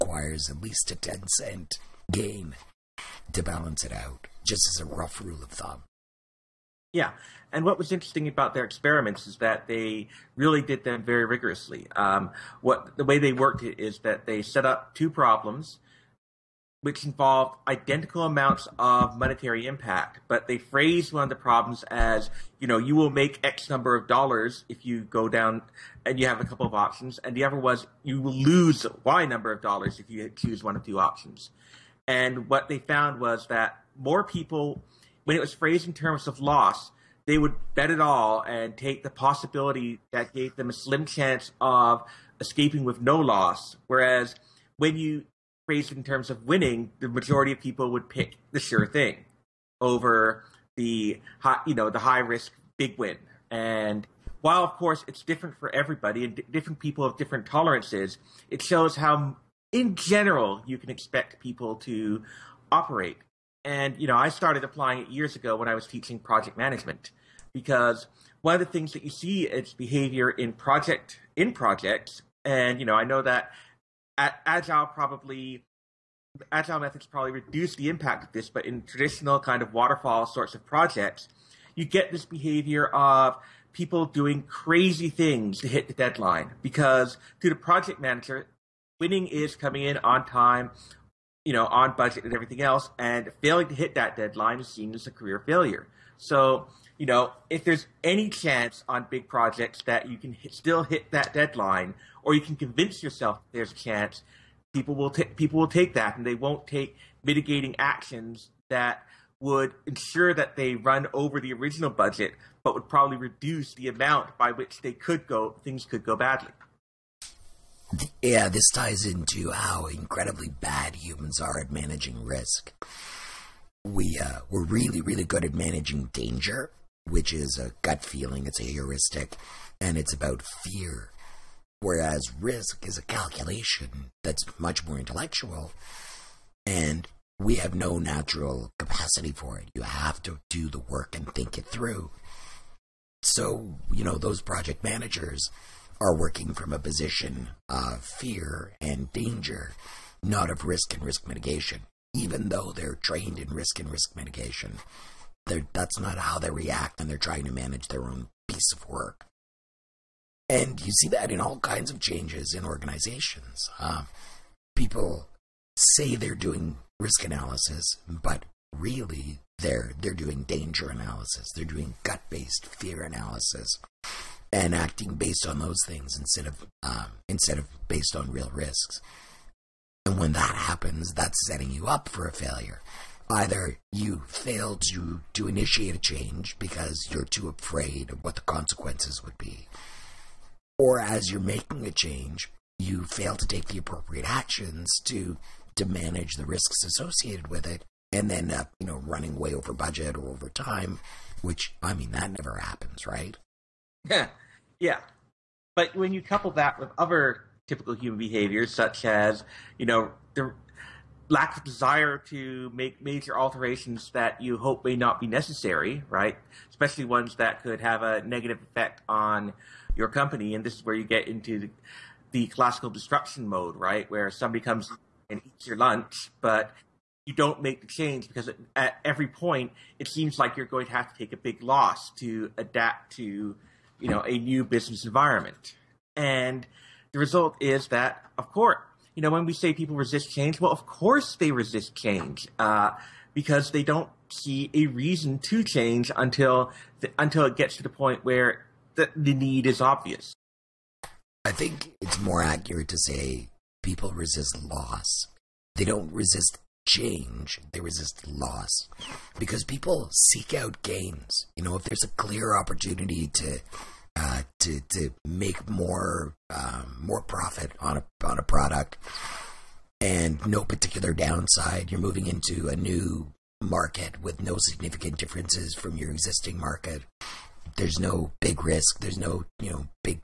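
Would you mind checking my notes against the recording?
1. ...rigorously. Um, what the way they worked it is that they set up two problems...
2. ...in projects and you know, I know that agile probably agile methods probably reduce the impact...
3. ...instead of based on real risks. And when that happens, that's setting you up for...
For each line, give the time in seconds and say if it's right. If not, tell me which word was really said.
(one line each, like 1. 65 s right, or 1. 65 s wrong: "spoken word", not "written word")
1. 11 s right
2. 71 s right
3. 177 s right.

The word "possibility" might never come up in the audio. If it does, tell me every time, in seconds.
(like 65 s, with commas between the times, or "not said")
39 s.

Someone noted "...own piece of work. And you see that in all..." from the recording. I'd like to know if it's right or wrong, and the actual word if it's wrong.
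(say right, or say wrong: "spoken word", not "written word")
right.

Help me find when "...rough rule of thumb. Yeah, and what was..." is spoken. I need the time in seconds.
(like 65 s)
4 s.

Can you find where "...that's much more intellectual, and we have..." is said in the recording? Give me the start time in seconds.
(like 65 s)
134 s.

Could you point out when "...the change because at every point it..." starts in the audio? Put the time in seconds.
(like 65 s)
227 s.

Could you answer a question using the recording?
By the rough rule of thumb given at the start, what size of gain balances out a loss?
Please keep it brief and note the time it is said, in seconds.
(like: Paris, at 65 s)
10 cent gain, at 0 s.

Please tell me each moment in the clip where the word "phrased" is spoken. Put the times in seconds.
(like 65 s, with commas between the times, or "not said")
20 s, 35 s, 45 s.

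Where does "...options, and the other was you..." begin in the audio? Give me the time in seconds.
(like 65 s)
26 s.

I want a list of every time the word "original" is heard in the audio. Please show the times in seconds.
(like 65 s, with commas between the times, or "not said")
111 s.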